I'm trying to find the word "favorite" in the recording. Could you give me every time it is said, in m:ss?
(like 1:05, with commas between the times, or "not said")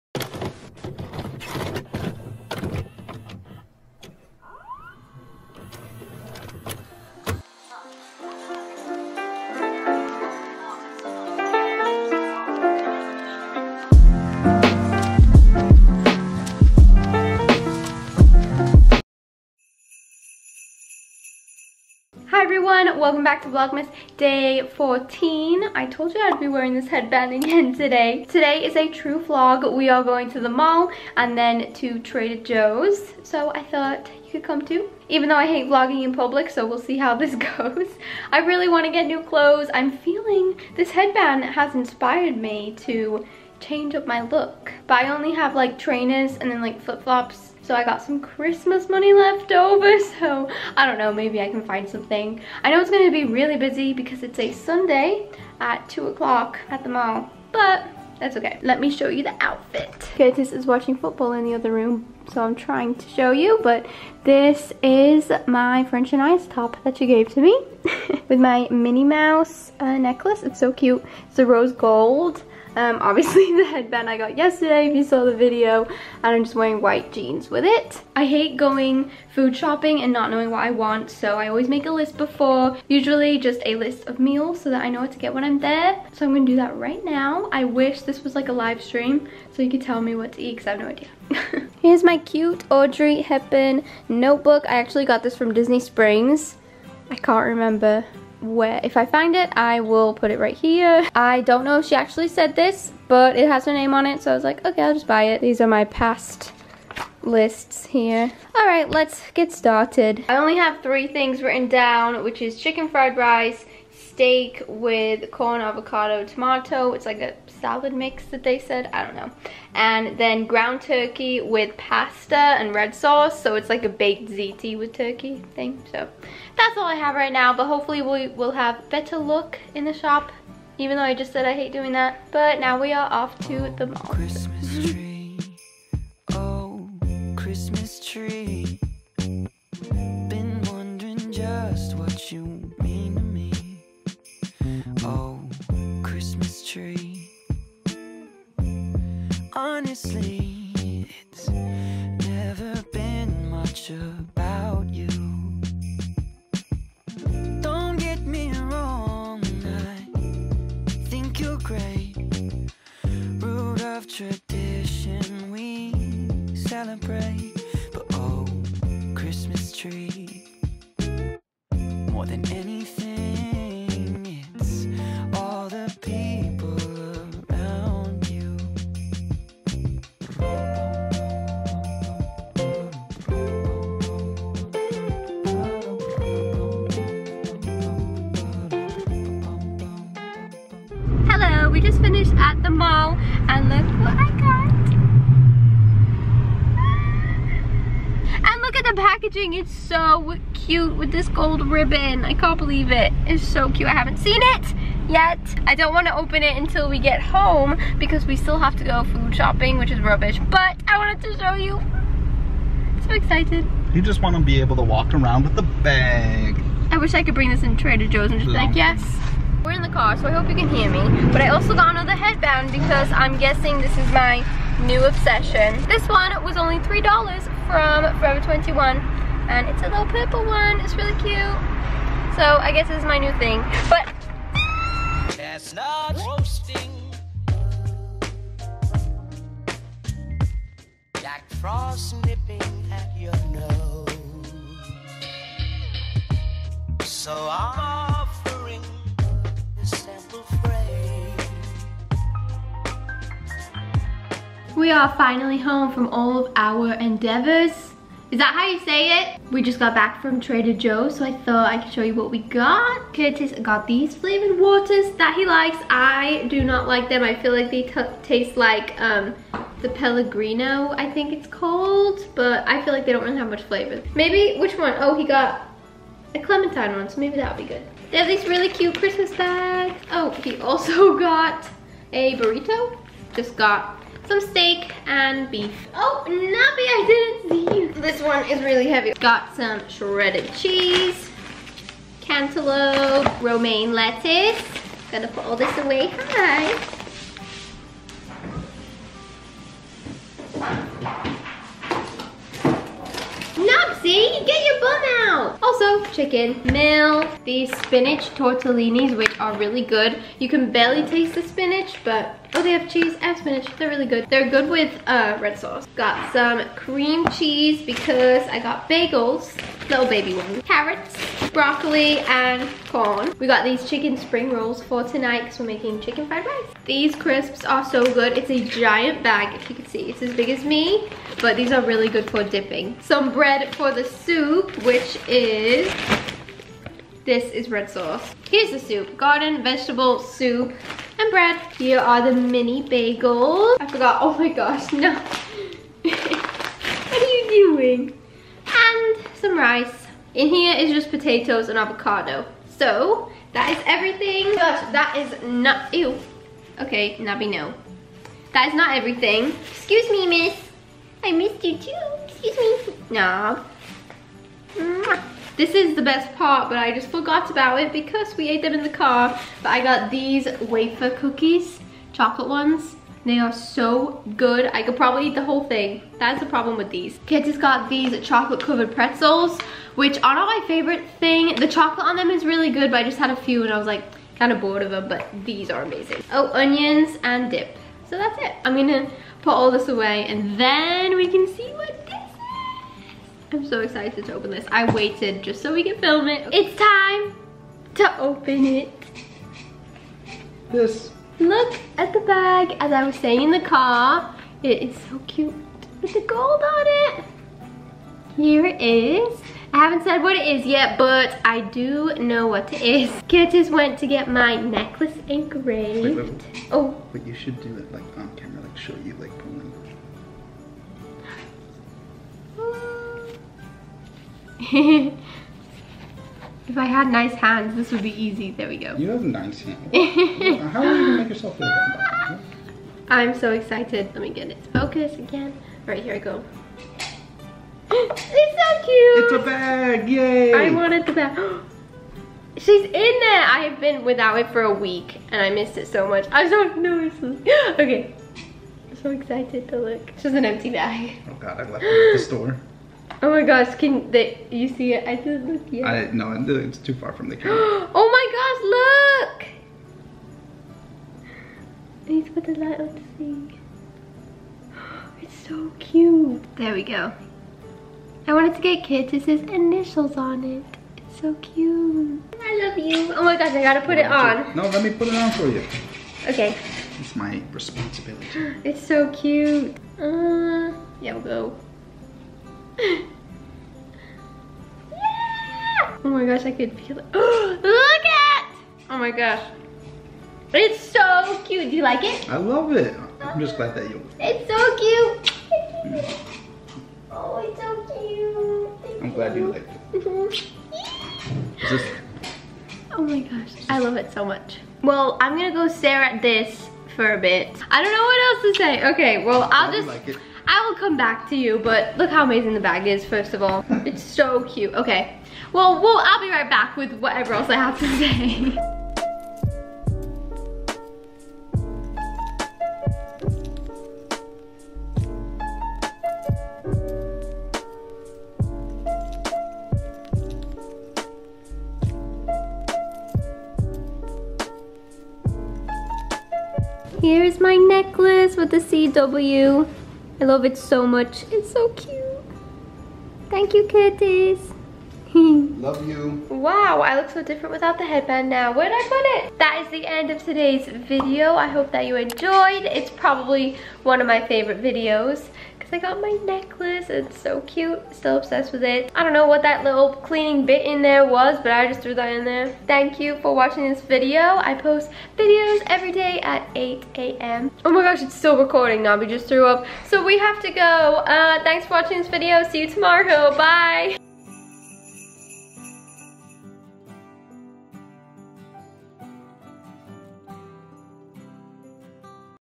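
6:20, 9:14.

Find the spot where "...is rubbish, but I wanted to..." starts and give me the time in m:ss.
3:29.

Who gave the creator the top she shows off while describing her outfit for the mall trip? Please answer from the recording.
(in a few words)
French and Ice.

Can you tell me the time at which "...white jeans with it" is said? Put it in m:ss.
1:16.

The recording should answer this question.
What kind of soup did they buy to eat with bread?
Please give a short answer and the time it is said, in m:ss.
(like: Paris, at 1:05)
Garden vegetable, at 5:39.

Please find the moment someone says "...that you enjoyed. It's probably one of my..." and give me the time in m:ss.
9:11.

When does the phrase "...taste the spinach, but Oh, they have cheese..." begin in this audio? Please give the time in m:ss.
5:11.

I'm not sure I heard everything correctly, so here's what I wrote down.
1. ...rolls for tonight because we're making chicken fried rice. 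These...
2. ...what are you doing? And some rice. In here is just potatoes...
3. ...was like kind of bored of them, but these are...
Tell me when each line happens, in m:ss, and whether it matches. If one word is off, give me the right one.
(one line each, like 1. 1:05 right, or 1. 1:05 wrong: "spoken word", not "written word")
1. 5:24 right
2. 5:46 right
3. 6:23 right.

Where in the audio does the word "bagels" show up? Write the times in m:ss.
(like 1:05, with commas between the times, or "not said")
5:18, 5:42.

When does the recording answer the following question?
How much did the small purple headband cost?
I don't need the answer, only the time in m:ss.
3:46.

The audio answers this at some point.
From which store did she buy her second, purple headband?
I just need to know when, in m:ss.
3:48.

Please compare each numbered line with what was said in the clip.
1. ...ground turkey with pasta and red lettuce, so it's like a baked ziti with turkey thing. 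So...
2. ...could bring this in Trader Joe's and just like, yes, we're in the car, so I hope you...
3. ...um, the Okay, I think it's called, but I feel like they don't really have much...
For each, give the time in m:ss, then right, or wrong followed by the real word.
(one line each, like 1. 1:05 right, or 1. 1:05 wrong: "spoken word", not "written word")
1. 2:00 wrong: "sauce", not "lettuce"
2. 3:37 right
3. 4:28 wrong: "Pellegrino", not "Okay".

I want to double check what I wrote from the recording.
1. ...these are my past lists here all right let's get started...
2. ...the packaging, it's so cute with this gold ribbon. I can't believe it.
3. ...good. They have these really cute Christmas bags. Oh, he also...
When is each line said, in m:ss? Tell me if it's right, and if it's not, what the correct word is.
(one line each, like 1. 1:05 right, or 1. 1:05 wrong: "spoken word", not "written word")
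1. 1:45 right
2. 3:18 right
3. 4:37 right.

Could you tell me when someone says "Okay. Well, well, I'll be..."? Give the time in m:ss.
8:34.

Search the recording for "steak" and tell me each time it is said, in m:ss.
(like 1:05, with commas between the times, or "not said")
1:53, 4:44.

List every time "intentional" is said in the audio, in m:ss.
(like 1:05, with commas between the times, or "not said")
not said.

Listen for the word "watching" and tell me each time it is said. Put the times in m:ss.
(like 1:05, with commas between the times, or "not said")
1:00, 9:23, 9:31.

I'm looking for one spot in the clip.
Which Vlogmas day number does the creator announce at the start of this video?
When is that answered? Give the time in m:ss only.
0:24.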